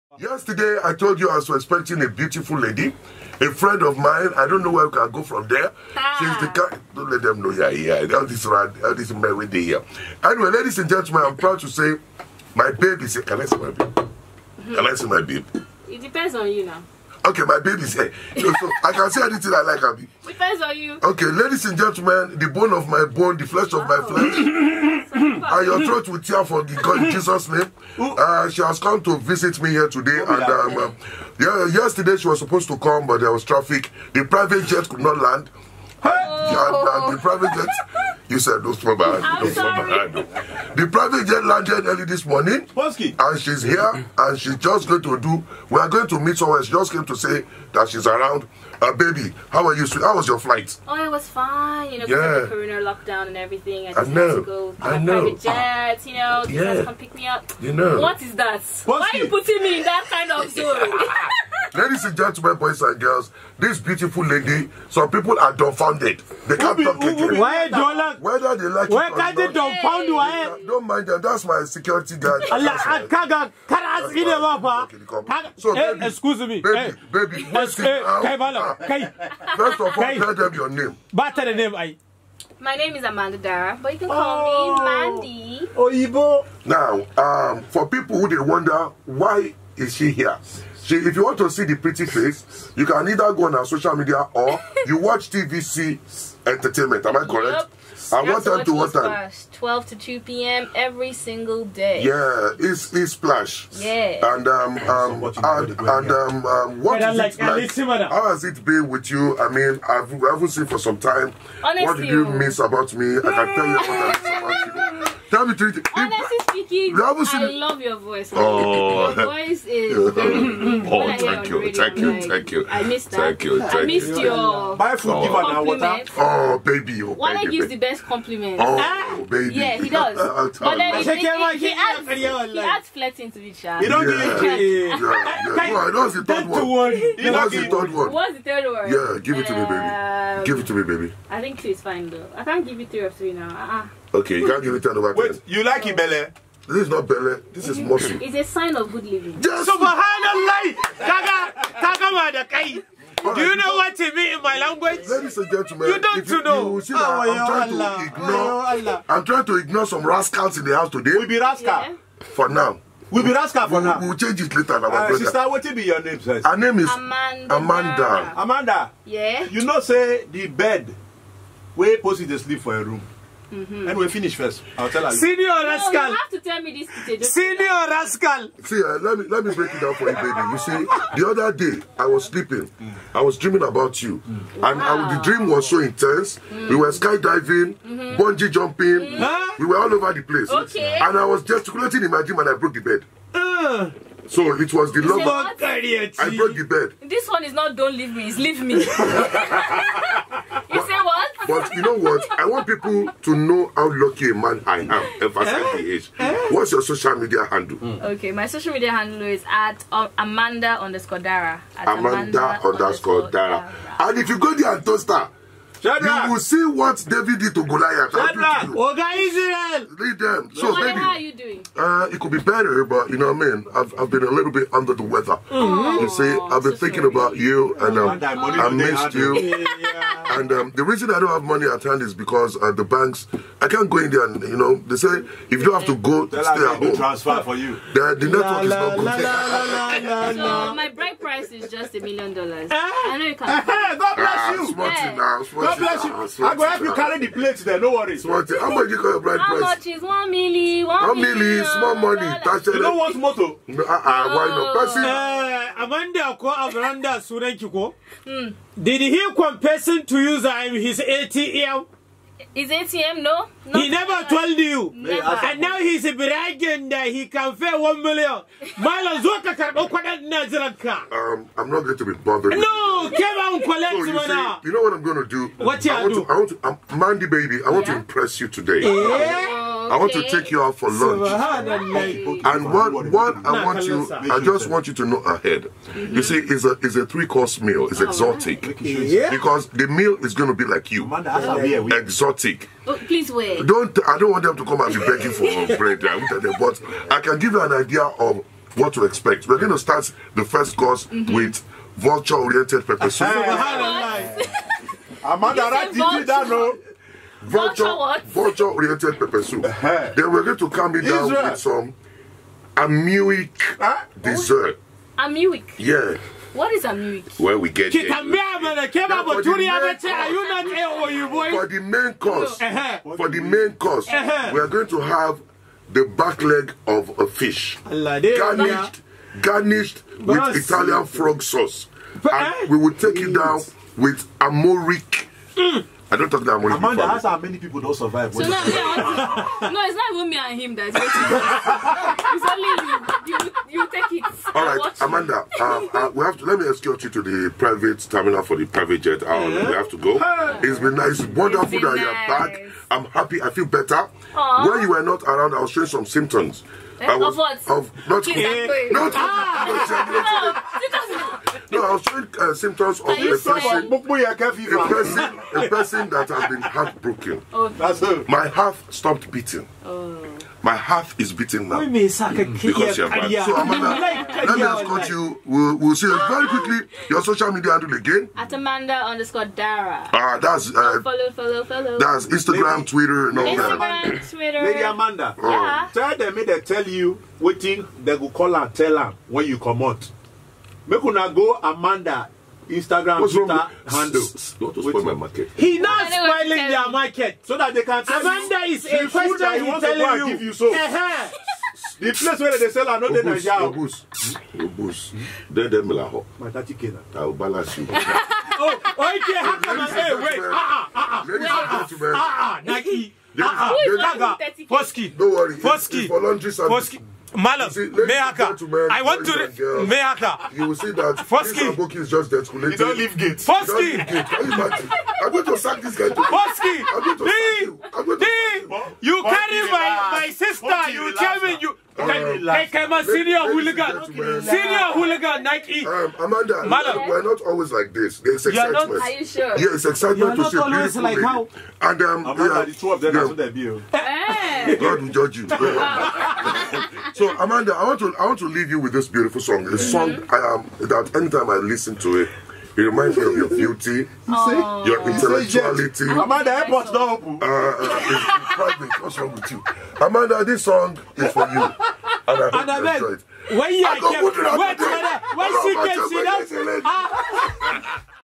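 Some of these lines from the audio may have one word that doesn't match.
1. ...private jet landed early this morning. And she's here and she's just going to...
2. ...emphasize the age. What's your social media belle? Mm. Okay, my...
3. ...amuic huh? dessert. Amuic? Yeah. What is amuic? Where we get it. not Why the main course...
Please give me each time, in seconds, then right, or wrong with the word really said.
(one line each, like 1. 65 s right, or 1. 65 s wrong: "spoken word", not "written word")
1. 40 s right
2. 205 s wrong: "handle", not "belle"
3. 312 s wrong: "For", not "Why".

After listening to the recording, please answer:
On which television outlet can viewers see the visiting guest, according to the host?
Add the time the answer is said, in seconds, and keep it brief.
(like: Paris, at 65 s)
TVC Entertainment, at 95 s.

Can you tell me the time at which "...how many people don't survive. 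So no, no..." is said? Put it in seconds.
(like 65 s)
337 s.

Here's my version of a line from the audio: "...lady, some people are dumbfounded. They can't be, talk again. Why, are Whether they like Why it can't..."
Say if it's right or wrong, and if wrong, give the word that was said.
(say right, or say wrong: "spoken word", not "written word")
right.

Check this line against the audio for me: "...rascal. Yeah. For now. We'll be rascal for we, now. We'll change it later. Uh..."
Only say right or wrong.
right.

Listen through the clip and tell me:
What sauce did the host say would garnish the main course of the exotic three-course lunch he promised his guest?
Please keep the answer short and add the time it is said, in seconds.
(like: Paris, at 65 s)
Italian frog sauce, at 330 s.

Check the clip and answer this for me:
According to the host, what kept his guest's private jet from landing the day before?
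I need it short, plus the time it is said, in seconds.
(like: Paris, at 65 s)
traffic, at 33 s.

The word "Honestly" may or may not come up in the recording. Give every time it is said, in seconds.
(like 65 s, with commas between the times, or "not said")
111 s, 115 s.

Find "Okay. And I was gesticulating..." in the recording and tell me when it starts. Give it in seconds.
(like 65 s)
190 s.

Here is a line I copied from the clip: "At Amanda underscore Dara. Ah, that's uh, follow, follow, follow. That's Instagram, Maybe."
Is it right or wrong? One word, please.
right.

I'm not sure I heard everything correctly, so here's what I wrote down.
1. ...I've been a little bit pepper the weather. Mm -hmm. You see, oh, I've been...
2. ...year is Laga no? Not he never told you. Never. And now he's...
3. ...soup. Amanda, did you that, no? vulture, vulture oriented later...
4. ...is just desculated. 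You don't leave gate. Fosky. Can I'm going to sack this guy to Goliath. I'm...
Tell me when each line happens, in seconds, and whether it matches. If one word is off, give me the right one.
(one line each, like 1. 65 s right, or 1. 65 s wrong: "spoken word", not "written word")
1. 223 s wrong: "under", not "pepper"
2. 261 s wrong: "ATM", not "Laga"
3. 303 s wrong: "pepper", not "later"
4. 421 s wrong: "Fosky", not "Goliath".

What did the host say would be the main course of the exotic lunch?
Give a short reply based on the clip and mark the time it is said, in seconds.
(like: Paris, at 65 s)
back leg of a fish, at 326 s.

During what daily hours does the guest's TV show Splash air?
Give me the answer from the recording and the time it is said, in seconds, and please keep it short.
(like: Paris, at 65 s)
12 to 2 p.m., at 99 s.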